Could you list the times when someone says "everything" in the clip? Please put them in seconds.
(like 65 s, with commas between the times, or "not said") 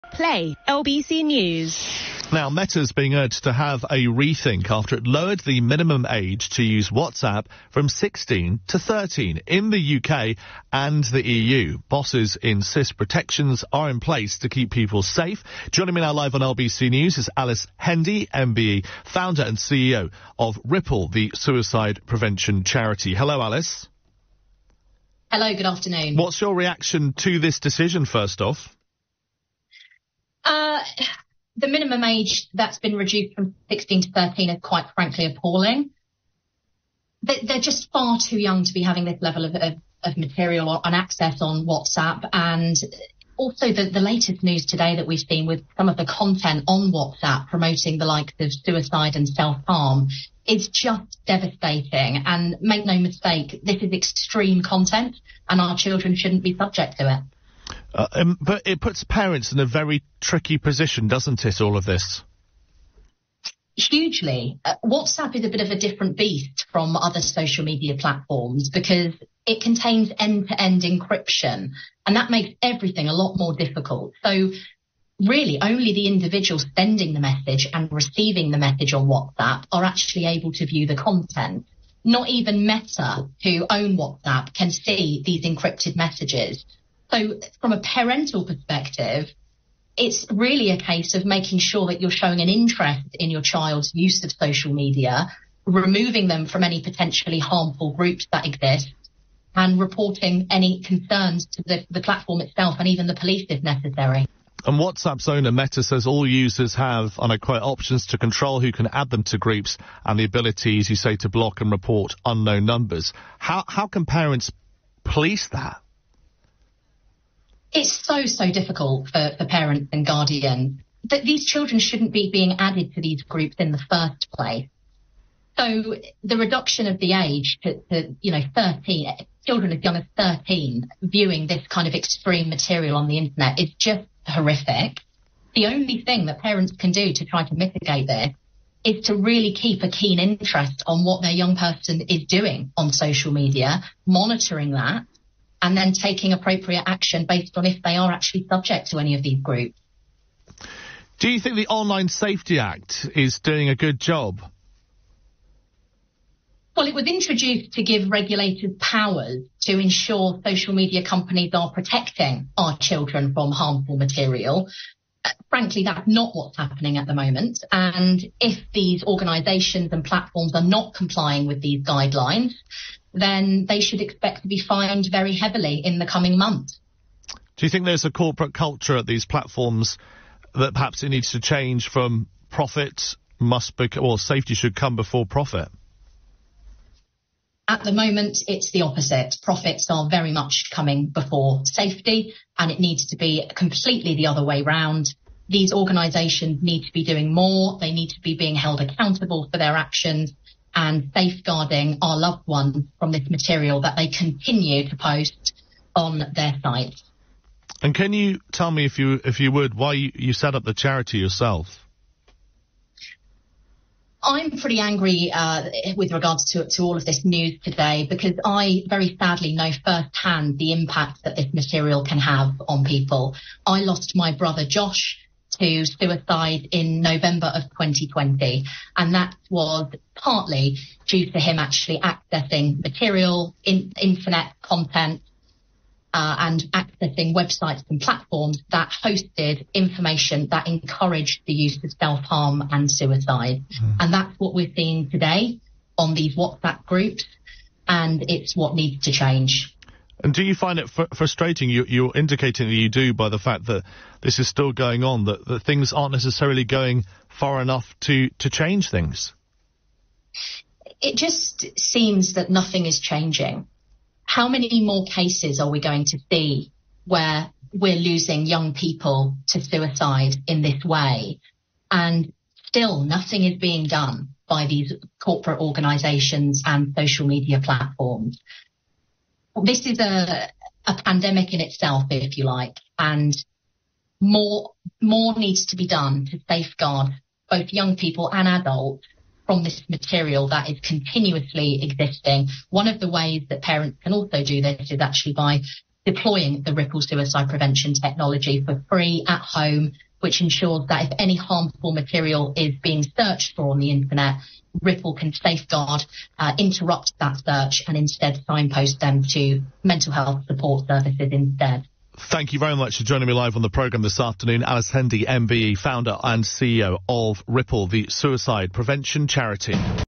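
72 s.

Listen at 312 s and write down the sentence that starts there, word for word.
Thank you very much for joining me live on the programme this afternoon.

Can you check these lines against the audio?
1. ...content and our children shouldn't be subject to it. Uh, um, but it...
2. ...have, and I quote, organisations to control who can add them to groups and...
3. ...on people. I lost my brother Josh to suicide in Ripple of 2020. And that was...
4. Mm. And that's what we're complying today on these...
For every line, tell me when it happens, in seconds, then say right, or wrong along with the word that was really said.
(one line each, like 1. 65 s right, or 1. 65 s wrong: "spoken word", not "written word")
1. 54 s right
2. 106 s wrong: "options", not "organisations"
3. 222 s wrong: "November", not "Ripple"
4. 243 s wrong: "seeing", not "complying".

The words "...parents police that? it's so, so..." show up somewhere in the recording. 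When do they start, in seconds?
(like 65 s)
114 s.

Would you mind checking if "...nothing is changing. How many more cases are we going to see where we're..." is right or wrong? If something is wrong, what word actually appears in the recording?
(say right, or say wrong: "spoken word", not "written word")
right.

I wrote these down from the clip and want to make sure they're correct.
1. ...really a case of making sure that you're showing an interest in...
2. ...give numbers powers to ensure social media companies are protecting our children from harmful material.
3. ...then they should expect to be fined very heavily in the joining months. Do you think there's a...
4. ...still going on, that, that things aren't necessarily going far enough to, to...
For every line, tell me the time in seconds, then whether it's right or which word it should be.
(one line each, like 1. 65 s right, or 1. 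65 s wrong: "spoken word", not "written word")
1. 90 s right
2. 157 s wrong: "regulators", not "numbers"
3. 173 s wrong: "coming", not "joining"
4. 254 s right.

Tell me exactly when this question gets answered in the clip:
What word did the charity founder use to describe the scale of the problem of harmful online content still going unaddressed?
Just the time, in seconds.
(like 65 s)
281 s.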